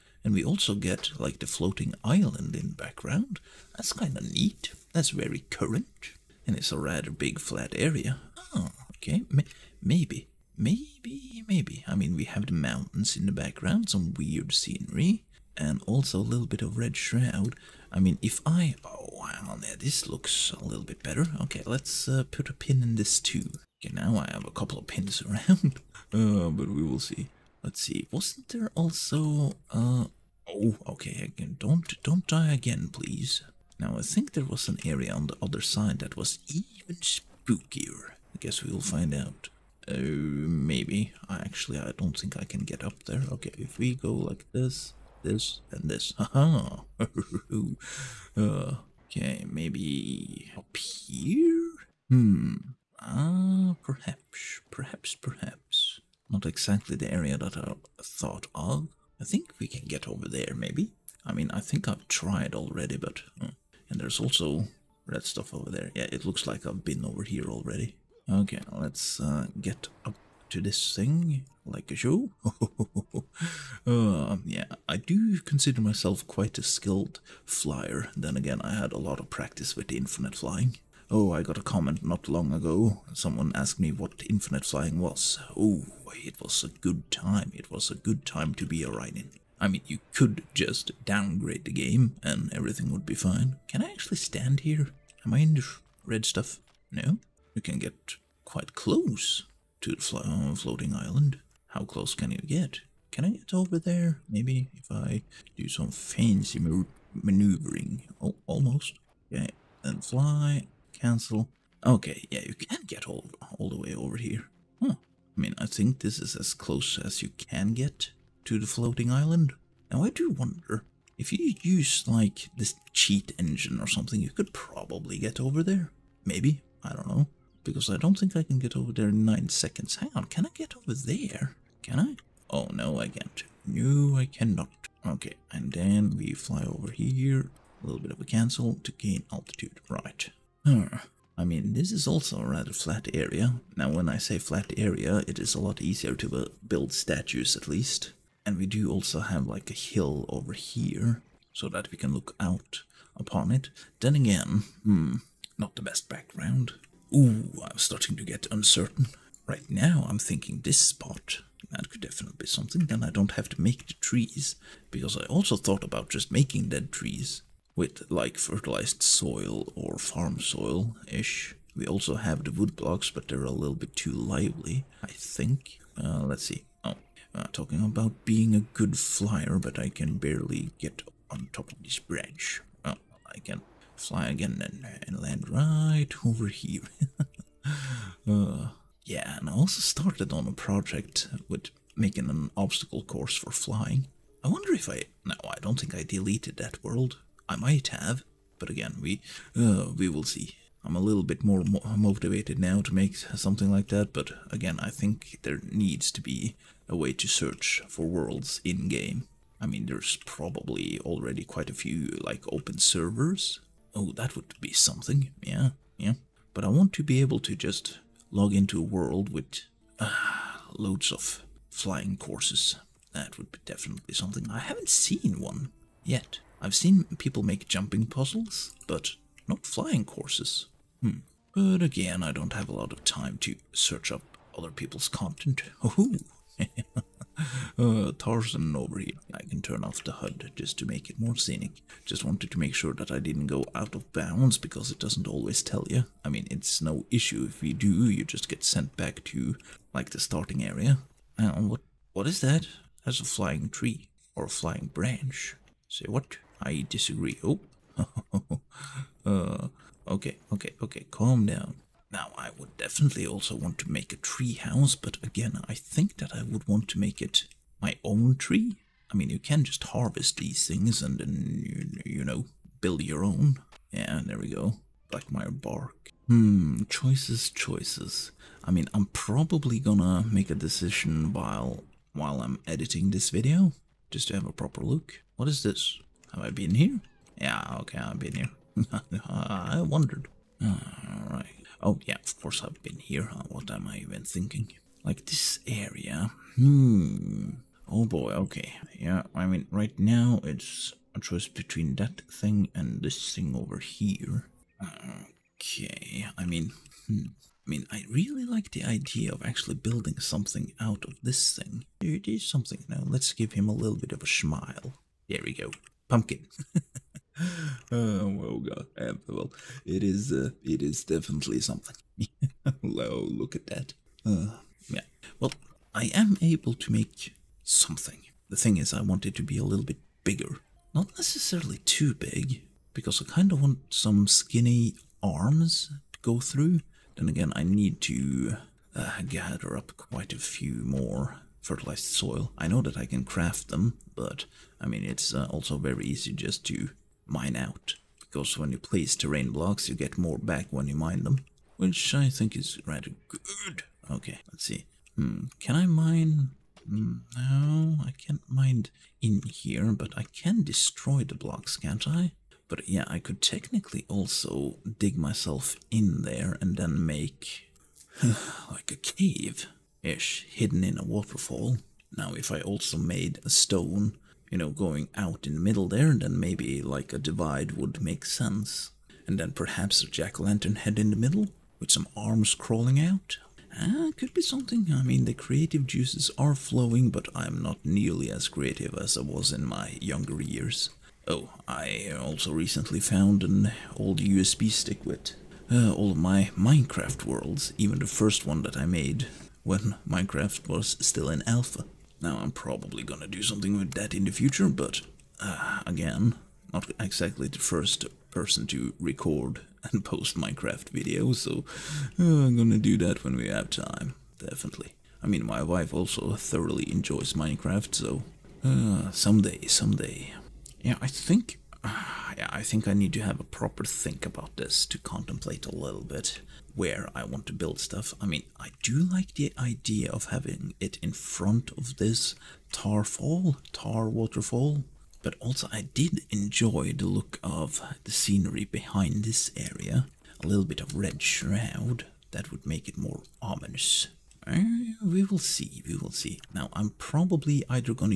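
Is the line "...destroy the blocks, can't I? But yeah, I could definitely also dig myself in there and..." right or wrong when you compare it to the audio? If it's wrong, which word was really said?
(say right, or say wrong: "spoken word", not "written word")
wrong: "technically", not "definitely".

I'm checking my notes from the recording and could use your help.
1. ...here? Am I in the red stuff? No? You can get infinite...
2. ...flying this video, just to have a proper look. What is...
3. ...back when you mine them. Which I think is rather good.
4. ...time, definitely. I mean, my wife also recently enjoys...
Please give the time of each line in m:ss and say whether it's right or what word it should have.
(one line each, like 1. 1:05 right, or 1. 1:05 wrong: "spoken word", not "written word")
1. 1:34 wrong: "quite", not "infinite"
2. 4:42 wrong: "editing", not "flying"
3. 5:50 right
4. 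6:53 wrong: "thoroughly", not "recently".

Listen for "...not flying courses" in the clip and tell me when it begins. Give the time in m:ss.
3:49.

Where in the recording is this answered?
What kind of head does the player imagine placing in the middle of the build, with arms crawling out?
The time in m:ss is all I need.
6:20.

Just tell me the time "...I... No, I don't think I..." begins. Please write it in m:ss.
3:14.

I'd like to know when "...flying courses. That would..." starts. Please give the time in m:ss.
3:41.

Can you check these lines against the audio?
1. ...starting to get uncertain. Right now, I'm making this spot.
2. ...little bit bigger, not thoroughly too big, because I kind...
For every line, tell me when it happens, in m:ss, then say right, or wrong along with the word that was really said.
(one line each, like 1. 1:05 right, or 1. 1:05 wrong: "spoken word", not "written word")
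1. 2:37 wrong: "thinking", not "making"
2. 5:29 wrong: "necessarily", not "thoroughly".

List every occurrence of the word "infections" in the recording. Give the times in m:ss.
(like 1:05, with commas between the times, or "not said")
not said.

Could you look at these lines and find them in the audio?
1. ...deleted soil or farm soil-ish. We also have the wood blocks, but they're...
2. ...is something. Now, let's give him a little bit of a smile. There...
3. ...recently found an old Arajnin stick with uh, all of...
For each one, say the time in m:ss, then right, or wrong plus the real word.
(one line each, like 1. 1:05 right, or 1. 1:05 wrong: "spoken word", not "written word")
1. 2:48 wrong: "fertilized", not "deleted"
2. 5:12 right
3. 6:32 wrong: "USB", not "Arajnin".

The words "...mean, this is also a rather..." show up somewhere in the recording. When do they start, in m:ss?
2:21.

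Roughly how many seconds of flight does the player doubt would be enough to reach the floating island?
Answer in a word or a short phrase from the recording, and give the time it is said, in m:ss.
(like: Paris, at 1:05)
9, at 2:09.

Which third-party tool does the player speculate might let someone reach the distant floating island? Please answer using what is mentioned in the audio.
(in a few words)
cheat engine.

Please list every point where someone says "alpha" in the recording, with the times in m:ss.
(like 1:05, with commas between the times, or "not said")
6:41.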